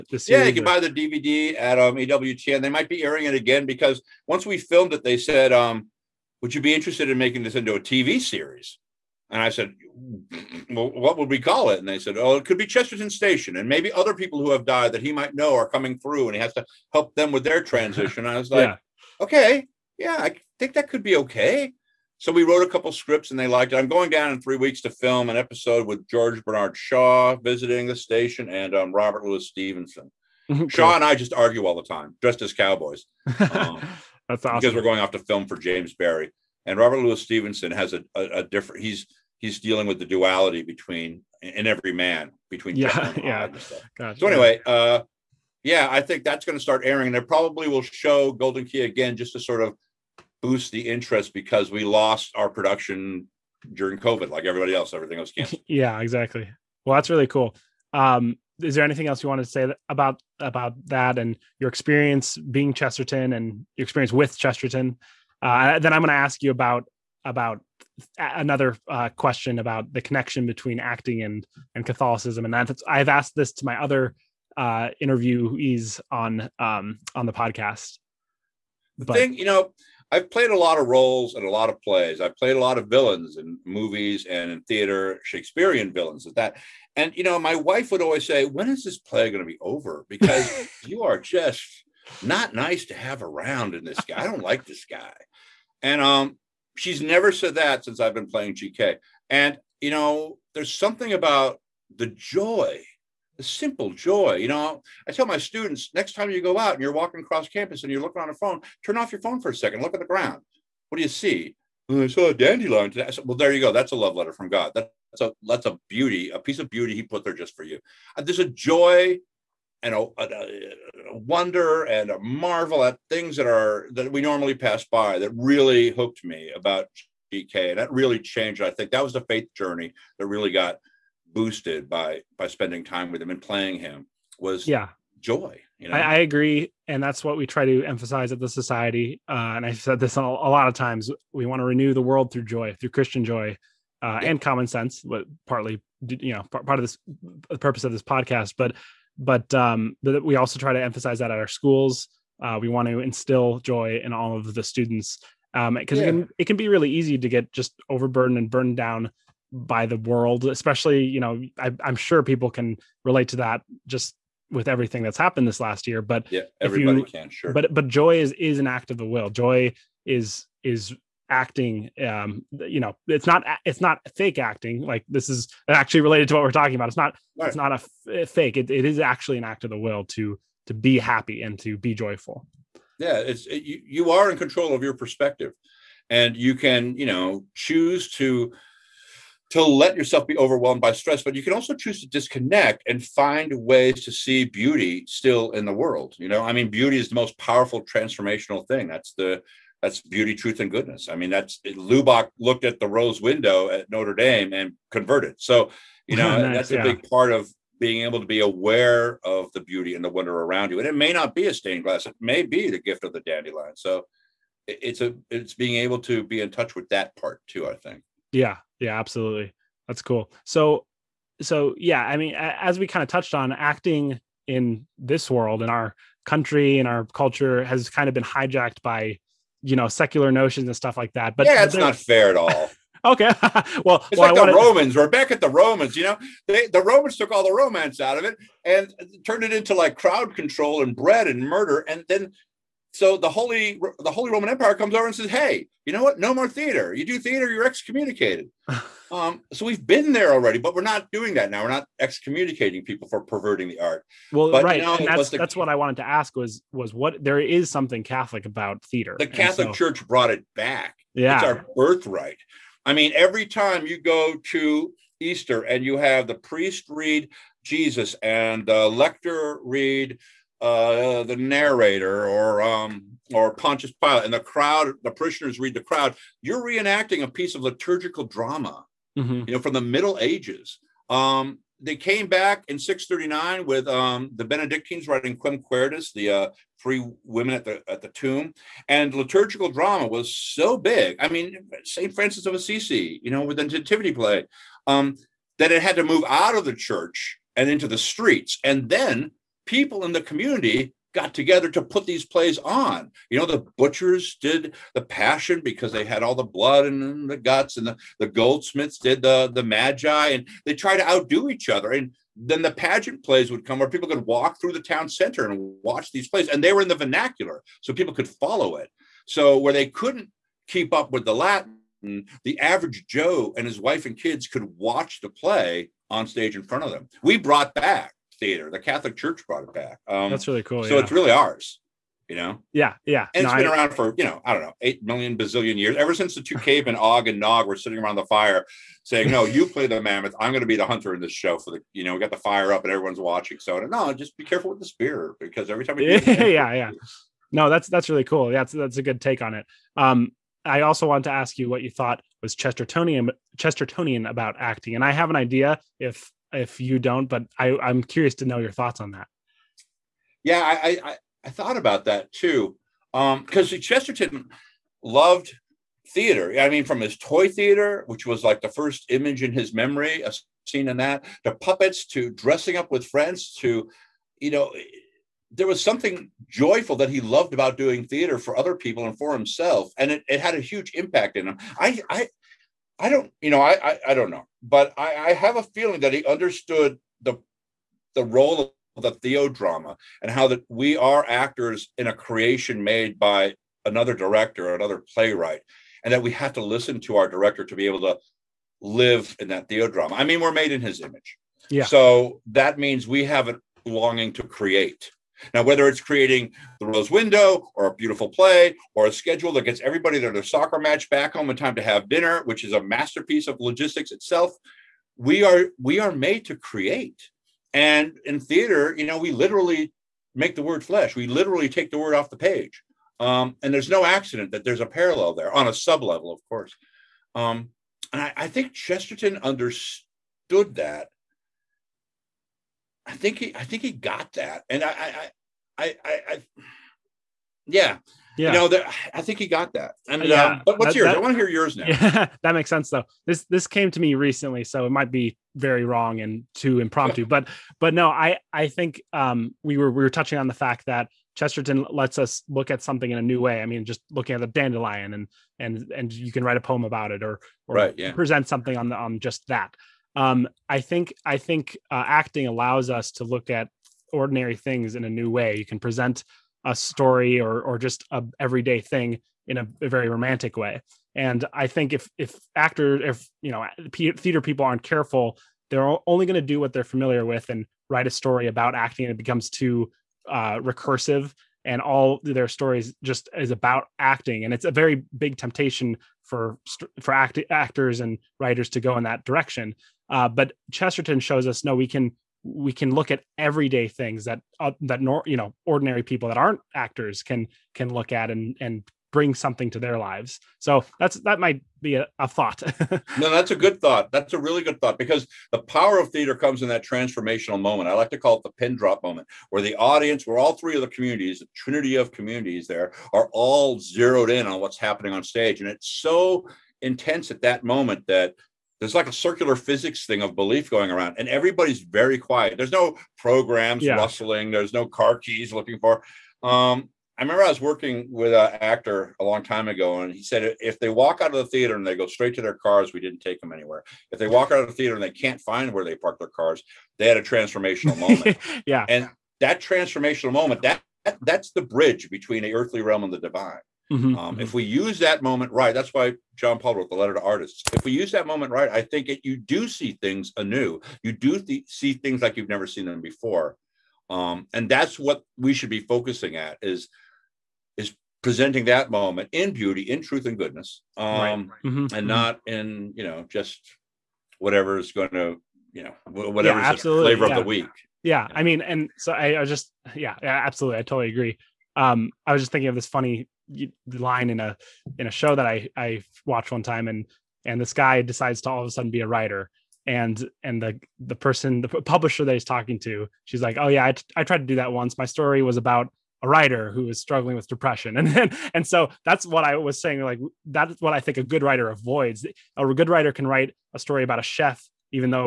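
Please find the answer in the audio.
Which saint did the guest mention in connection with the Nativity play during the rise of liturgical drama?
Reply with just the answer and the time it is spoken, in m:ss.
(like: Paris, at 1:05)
Saint Francis of Assisi, at 4:51.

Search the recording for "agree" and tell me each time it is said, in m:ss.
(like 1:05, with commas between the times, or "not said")
2:16, 9:31.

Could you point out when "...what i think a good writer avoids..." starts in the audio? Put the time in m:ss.
9:50.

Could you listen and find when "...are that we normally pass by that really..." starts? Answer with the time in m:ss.
2:03.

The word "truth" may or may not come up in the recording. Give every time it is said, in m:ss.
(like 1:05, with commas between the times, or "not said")
3:20, 9:20.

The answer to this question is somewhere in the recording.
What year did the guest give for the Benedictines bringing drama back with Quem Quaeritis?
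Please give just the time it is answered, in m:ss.
4:42.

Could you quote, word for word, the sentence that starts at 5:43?
So no, just be careful with the spear because every time.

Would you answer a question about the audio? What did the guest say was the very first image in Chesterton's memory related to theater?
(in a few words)
His toy theater.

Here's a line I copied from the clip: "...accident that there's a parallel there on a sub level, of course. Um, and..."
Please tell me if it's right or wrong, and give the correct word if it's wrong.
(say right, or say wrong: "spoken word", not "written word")
right.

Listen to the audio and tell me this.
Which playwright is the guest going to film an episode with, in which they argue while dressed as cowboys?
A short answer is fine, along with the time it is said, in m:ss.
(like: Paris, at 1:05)
George Bernard Shaw, at 0:26.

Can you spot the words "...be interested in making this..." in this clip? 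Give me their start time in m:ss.
0:06.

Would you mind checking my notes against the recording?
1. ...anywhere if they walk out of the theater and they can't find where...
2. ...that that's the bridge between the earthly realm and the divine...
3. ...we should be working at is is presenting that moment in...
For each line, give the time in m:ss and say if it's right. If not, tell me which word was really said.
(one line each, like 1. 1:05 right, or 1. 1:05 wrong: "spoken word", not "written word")
1. 8:53 right
2. 9:01 right
3. 9:15 wrong: "focusing", not "working".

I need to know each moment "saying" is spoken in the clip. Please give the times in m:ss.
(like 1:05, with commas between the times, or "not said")
5:39, 9:49.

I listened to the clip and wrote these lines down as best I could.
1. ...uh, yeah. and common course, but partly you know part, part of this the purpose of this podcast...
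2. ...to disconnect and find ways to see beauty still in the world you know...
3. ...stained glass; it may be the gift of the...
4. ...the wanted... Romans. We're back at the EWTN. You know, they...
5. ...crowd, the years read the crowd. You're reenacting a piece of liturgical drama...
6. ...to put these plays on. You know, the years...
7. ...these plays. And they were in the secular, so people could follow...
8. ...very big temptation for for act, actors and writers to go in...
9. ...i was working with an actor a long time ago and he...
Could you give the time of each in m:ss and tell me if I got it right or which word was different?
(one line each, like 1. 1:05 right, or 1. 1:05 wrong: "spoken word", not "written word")
1. 2:24 wrong: "sense", not "course"
2. 3:12 right
3. 3:31 right
4. 3:54 wrong: "Romans", not "EWTN"
5. 4:34 wrong: "parishioners", not "years"
6. 5:01 wrong: "butchers", not "years"
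7. 5:16 wrong: "vernacular", not "secular"
8. 8:04 right
9. 8:47 right.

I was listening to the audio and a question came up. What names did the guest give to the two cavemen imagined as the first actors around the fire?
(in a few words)
Og and Nog.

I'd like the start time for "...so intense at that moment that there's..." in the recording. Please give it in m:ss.
8:35.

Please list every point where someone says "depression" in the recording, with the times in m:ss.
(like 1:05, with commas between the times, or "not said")
9:47.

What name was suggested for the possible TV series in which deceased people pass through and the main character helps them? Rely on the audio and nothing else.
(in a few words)
Chesterton Station.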